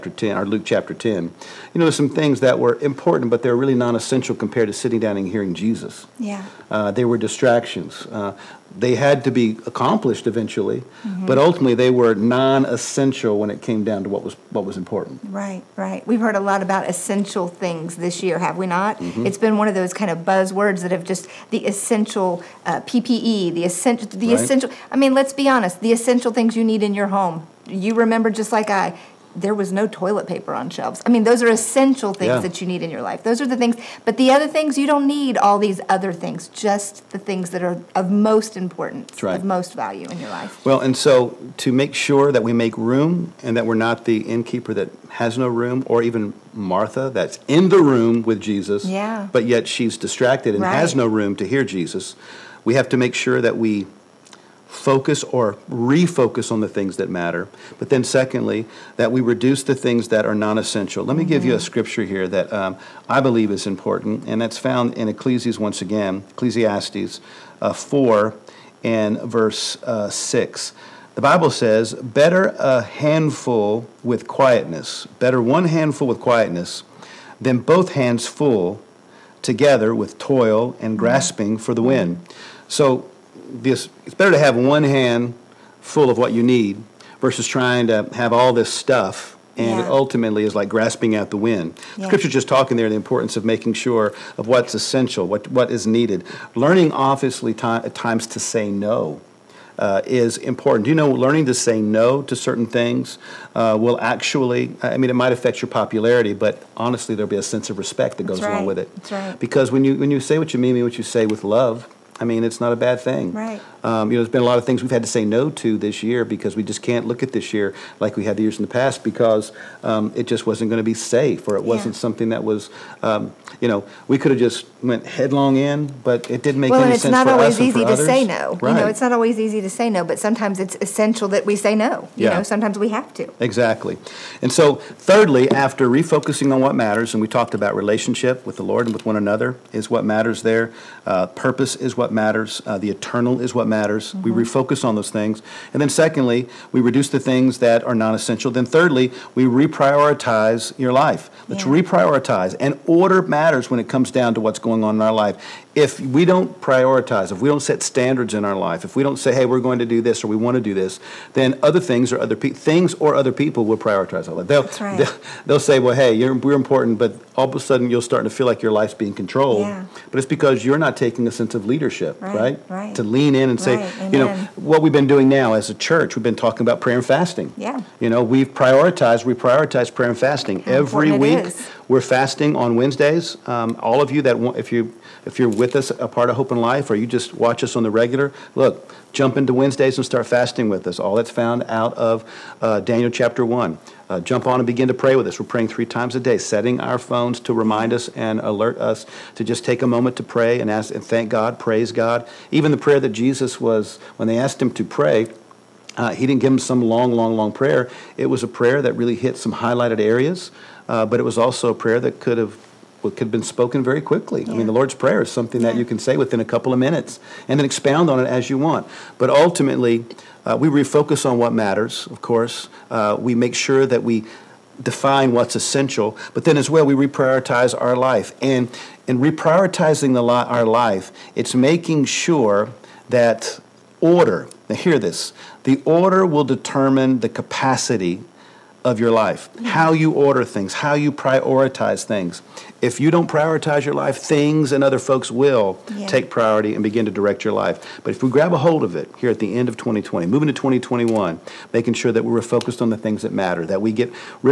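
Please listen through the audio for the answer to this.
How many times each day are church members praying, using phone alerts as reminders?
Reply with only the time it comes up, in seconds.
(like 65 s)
195 s.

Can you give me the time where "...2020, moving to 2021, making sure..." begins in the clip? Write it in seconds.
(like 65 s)
249 s.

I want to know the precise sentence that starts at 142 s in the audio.
Uh, the eternal is what matters.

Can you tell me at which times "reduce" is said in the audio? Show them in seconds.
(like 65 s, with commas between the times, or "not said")
59 s, 146 s.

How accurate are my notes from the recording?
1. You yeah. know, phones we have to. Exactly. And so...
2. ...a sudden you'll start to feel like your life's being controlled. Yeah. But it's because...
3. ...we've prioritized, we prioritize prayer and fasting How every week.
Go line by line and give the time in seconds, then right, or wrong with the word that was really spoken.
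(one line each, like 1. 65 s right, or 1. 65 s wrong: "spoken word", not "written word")
1. 132 s wrong: "sometimes", not "phones"
2. 167 s right
3. 178 s right.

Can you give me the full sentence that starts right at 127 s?
Well, it's not always easy to others.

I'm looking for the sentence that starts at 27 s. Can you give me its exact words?
You remember just like I there was no toilet paper on shelves.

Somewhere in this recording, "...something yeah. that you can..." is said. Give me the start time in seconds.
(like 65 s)
215 s.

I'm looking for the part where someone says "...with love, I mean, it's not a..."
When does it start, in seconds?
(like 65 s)
111 s.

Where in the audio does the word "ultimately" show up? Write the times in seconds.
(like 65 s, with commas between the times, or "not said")
11 s, 89 s, 219 s.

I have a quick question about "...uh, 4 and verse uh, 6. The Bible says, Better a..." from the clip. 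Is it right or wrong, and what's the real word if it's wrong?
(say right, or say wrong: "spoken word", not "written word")
right.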